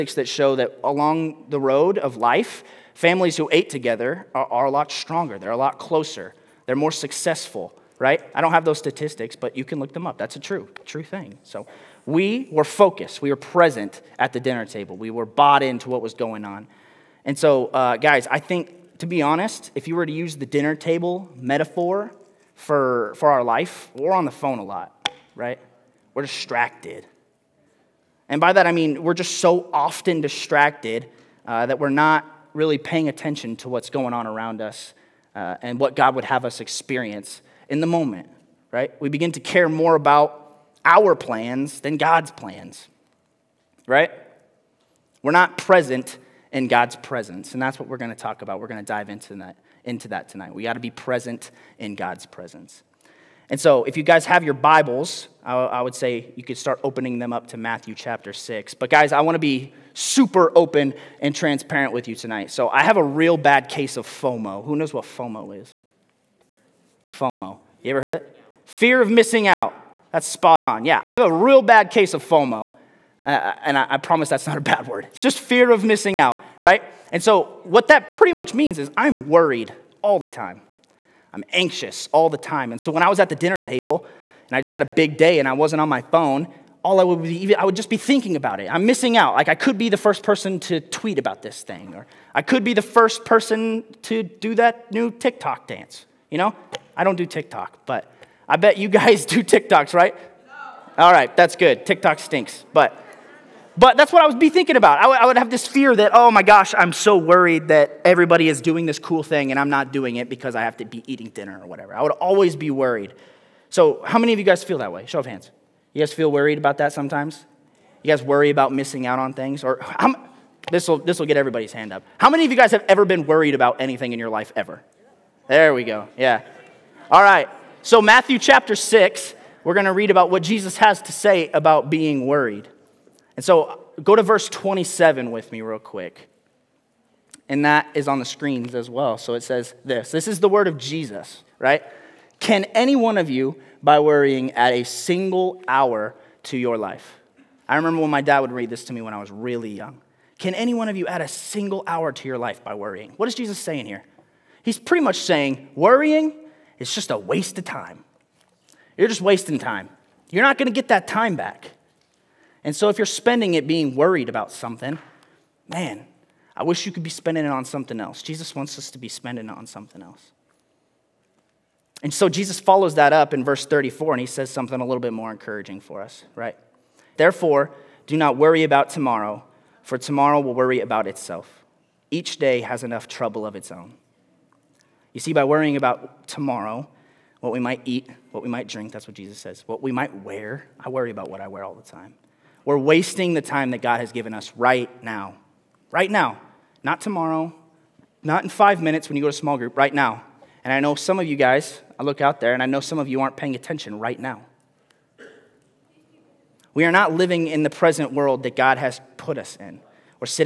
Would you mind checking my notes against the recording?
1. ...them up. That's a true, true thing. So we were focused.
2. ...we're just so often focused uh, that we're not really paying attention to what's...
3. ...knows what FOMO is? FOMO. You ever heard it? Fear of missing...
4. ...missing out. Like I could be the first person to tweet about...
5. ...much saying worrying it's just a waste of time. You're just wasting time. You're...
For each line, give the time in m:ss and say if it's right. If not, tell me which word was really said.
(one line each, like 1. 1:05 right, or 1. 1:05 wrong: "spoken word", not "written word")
1. 0:09 right
2. 0:29 wrong: "distracted", not "focused"
3. 1:04 right
4. 1:28 right
5. 2:35 right.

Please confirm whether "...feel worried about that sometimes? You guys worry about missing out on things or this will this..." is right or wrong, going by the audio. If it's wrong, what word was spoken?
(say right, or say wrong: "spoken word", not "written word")
right.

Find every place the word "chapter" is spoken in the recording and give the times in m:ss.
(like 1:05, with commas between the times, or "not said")
0:57, 2:08.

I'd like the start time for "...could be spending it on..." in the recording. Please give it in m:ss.
2:46.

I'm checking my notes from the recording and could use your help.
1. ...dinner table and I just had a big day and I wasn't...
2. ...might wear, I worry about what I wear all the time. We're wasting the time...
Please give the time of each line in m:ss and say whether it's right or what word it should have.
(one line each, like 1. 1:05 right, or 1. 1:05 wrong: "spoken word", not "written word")
1. 1:23 right
2. 3:09 right.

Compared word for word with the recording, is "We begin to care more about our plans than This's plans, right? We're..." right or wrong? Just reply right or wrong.
wrong.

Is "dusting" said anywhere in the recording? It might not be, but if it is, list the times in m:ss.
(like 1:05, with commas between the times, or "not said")
not said.